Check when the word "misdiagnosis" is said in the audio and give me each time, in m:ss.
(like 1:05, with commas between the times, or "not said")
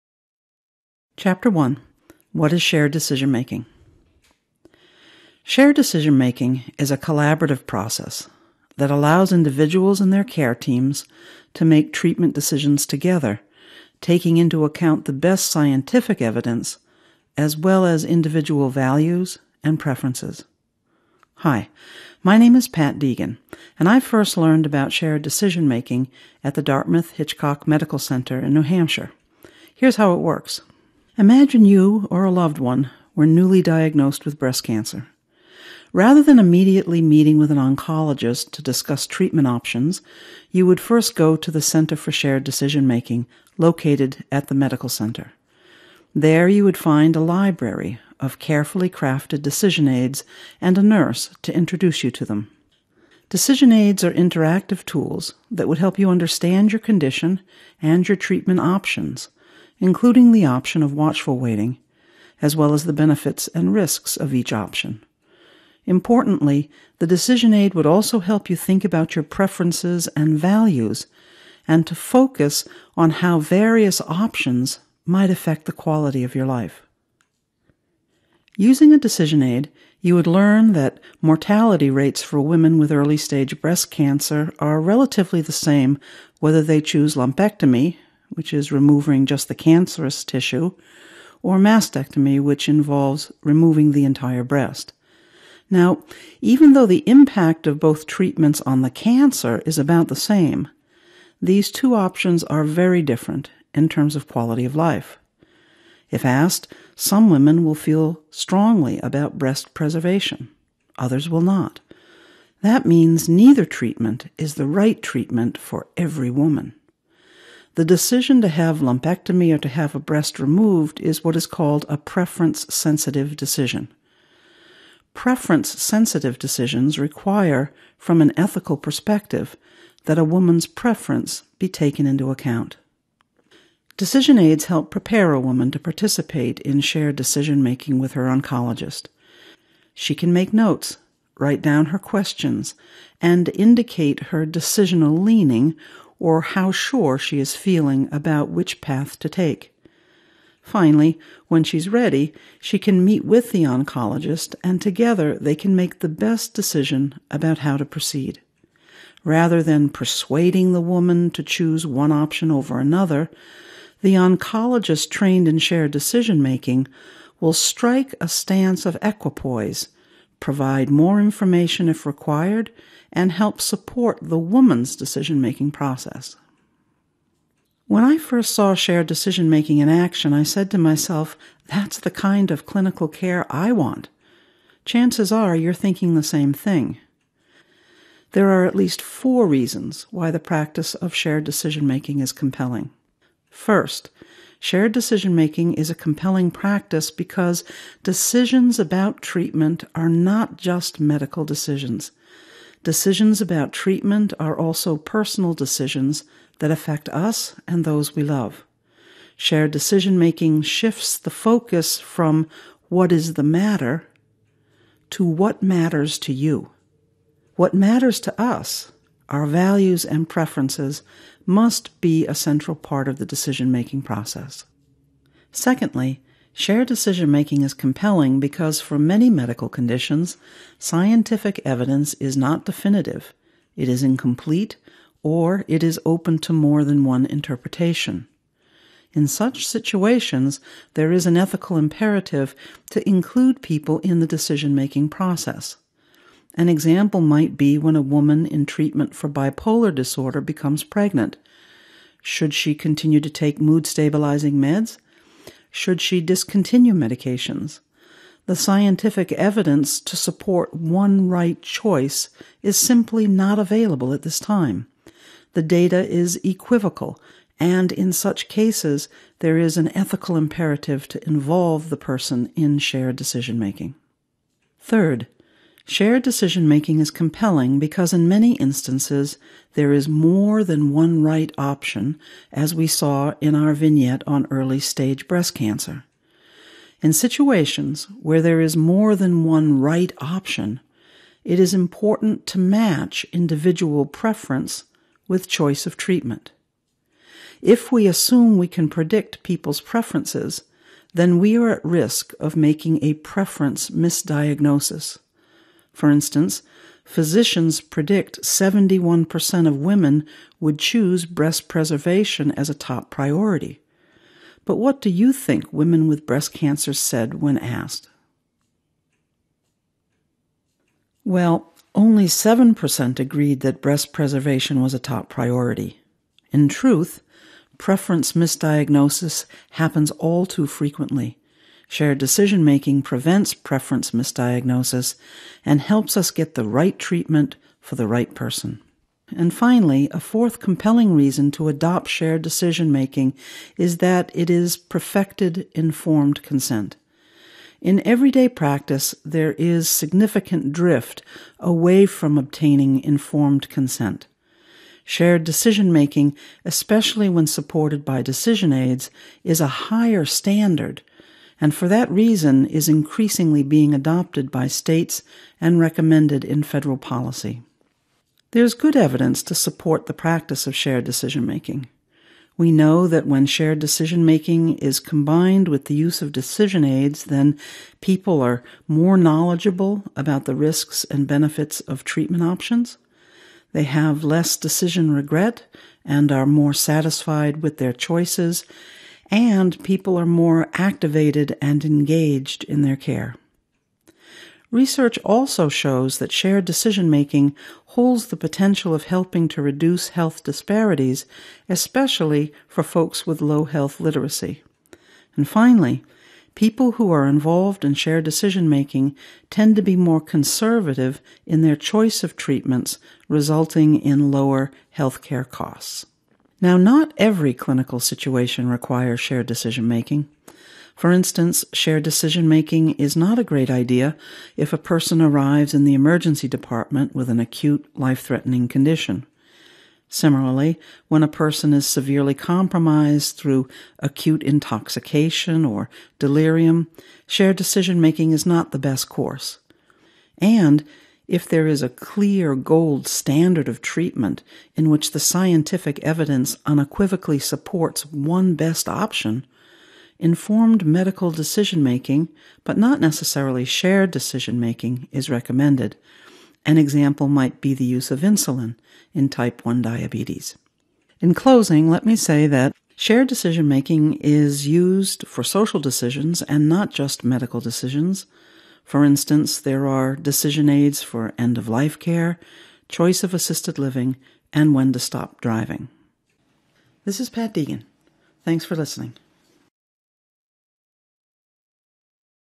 5:03, 5:28, 5:34.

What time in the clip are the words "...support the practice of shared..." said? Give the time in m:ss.
6:09.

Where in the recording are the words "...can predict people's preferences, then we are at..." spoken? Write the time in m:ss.
4:58.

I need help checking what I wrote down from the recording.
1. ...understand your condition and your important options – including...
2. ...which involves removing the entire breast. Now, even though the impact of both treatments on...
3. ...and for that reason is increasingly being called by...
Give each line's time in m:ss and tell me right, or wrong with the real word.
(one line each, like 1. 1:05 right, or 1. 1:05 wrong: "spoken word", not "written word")
1. 0:56 wrong: "treatment", not "important"
2. 1:32 right
3. 6:01 wrong: "adopted", not "called".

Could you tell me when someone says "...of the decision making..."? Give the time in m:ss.
3:43.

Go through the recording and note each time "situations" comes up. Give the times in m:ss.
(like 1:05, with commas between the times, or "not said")
3:59, 4:47, 6:57.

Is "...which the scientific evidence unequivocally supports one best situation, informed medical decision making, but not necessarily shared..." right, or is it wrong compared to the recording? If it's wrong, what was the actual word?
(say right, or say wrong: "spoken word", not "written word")
wrong: "option", not "situation".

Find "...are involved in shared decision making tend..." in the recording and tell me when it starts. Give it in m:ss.
6:47.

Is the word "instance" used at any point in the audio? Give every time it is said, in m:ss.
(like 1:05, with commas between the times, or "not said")
4:38, 5:06, 7:01, 7:49.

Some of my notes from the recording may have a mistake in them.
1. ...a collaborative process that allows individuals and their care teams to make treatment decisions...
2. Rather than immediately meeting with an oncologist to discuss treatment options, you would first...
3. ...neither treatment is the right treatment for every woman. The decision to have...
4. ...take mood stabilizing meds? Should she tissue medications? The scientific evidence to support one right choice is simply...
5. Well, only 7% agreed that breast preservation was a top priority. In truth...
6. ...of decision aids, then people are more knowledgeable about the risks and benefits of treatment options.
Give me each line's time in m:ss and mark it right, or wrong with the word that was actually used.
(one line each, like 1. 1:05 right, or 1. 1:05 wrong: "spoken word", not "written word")
1. 0:06 right
2. 0:35 right
3. 1:53 right
4. 4:13 wrong: "discontinue", not "tissue"
5. 5:21 right
6. 6:16 right.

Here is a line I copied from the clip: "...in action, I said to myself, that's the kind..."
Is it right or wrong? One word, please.
right.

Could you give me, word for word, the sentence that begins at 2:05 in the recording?
Preference sensitive decisions require, from an ethical perspective, that a woman's preference be taken into account.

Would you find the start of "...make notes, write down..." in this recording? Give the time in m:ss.
2:20.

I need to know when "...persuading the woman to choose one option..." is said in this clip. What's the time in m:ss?
2:39.